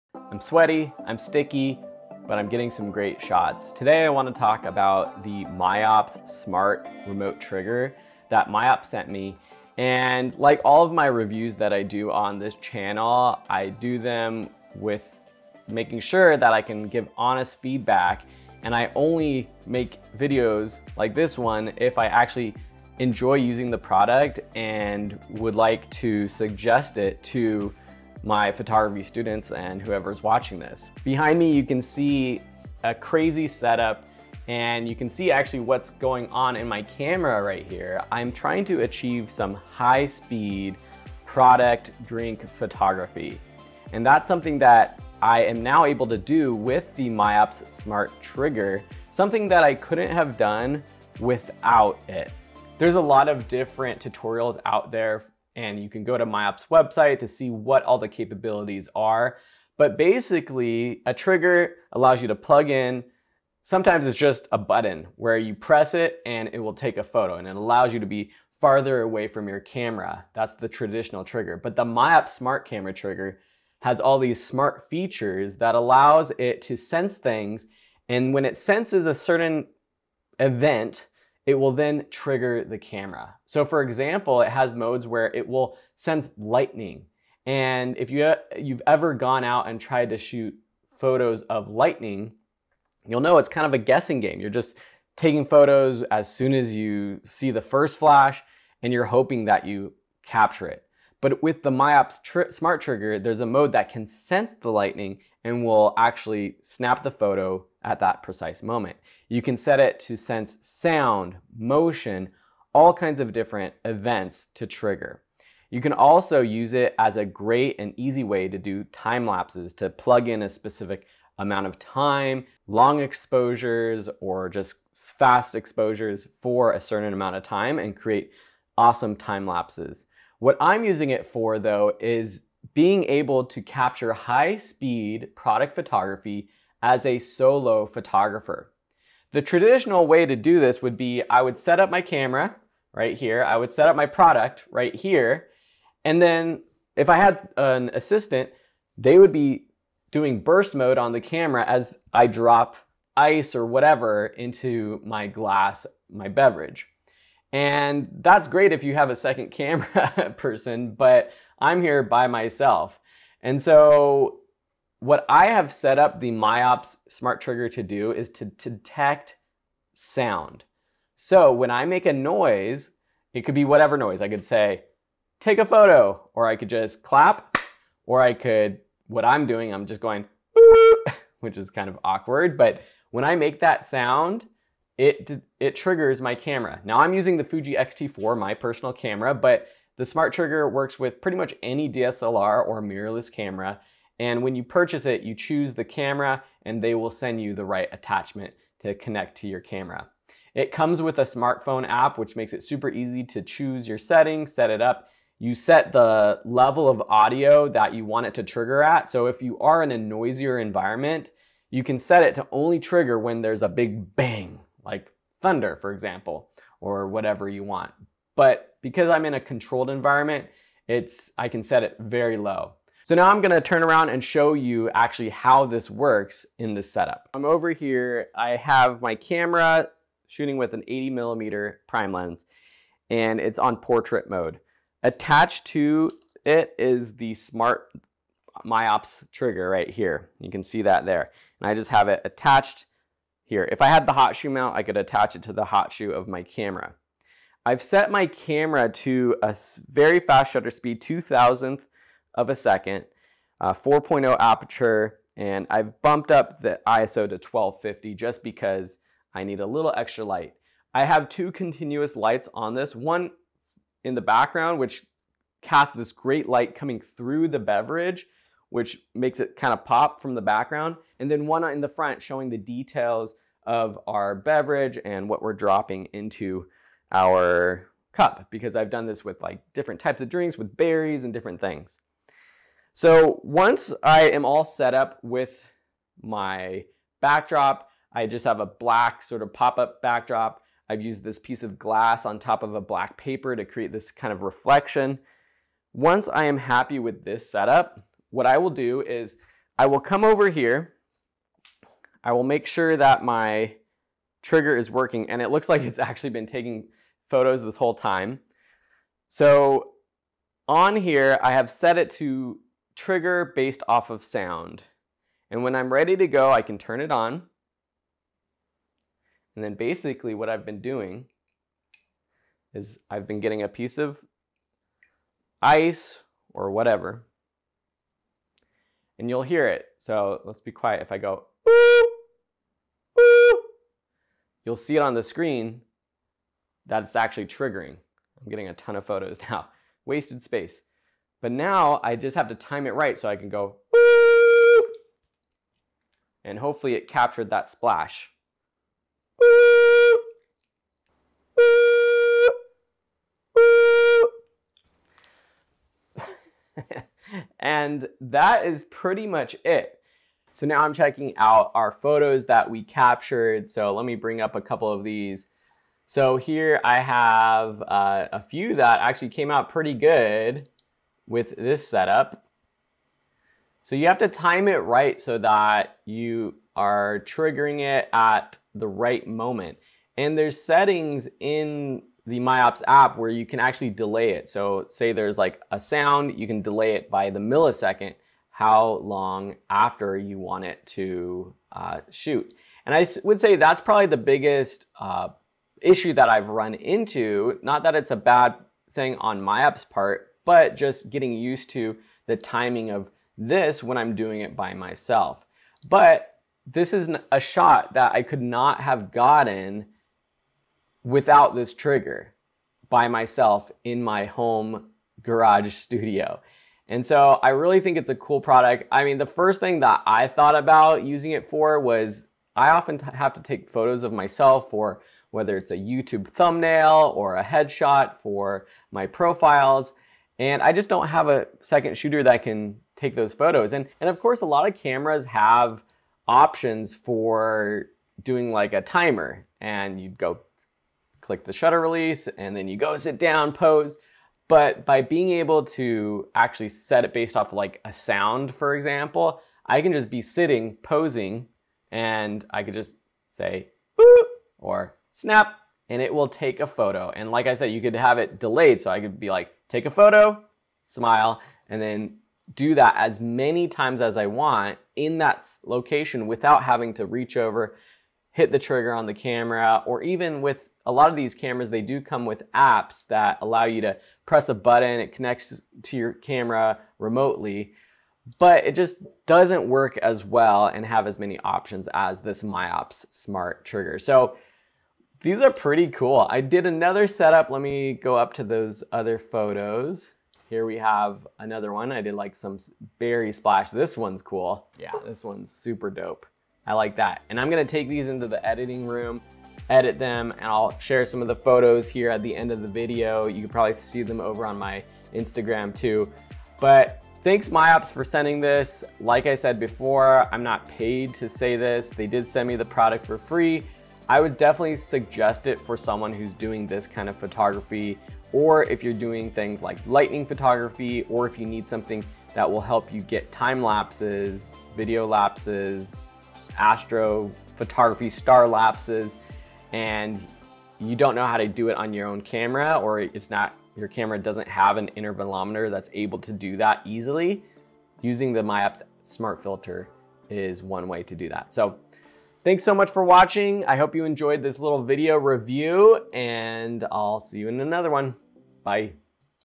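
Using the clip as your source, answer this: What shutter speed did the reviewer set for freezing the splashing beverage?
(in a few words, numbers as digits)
2,000th of a second.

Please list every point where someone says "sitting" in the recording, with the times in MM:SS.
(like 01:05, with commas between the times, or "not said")
07:30.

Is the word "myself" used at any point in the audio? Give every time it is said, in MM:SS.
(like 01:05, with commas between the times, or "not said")
02:42, 06:44, 06:53, 07:04.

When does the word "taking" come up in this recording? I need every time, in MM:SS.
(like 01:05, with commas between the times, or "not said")
01:35, 05:06.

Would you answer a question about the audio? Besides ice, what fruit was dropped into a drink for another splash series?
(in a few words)
Berries.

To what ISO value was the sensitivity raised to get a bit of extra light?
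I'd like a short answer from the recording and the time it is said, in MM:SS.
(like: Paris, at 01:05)
1250, at 04:17.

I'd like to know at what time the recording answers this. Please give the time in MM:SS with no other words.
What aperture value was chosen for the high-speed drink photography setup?
04:13.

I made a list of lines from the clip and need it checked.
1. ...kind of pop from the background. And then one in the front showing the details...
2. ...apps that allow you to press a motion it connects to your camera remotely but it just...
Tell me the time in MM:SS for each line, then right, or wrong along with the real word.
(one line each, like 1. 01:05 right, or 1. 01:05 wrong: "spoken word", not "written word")
1. 04:29 right
2. 07:52 wrong: "button", not "motion".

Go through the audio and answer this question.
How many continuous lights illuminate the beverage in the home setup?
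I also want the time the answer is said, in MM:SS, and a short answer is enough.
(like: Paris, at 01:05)
Two, at 04:21.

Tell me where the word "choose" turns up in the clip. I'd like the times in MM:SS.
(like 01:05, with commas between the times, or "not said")
03:15, 03:23.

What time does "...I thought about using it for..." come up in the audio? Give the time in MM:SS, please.
07:00.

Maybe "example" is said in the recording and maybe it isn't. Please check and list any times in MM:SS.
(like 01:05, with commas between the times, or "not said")
01:23, 03:35, 07:28.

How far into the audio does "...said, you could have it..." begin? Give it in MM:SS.
07:37.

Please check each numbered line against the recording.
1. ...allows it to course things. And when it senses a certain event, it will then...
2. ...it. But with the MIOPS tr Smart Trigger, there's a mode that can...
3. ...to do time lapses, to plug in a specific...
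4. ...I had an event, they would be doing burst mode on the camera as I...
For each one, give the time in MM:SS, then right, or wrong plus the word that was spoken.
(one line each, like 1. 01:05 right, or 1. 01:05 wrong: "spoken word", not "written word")
1. 01:15 wrong: "sense", not "course"
2. 01:40 right
3. 01:58 right
4. 02:27 wrong: "assistant", not "event".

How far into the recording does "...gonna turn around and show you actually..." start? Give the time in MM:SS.
03:43.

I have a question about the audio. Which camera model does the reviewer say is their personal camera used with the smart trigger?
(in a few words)
Fuji X-T4.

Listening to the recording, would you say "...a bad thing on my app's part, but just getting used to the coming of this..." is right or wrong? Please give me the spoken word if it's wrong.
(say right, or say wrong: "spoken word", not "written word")
wrong: "timing", not "coming".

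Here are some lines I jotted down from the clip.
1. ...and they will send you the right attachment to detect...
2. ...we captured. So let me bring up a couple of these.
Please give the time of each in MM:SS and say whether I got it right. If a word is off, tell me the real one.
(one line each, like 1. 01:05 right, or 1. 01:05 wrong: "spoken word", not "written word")
1. 03:16 wrong: "connect", not "detect"
2. 06:02 right.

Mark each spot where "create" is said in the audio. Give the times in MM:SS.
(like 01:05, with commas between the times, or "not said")
02:07, 04:53.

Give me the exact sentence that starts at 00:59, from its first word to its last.
But basically, a trigger allows you to plug in.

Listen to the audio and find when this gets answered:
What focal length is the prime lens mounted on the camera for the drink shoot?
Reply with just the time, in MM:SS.
03:50.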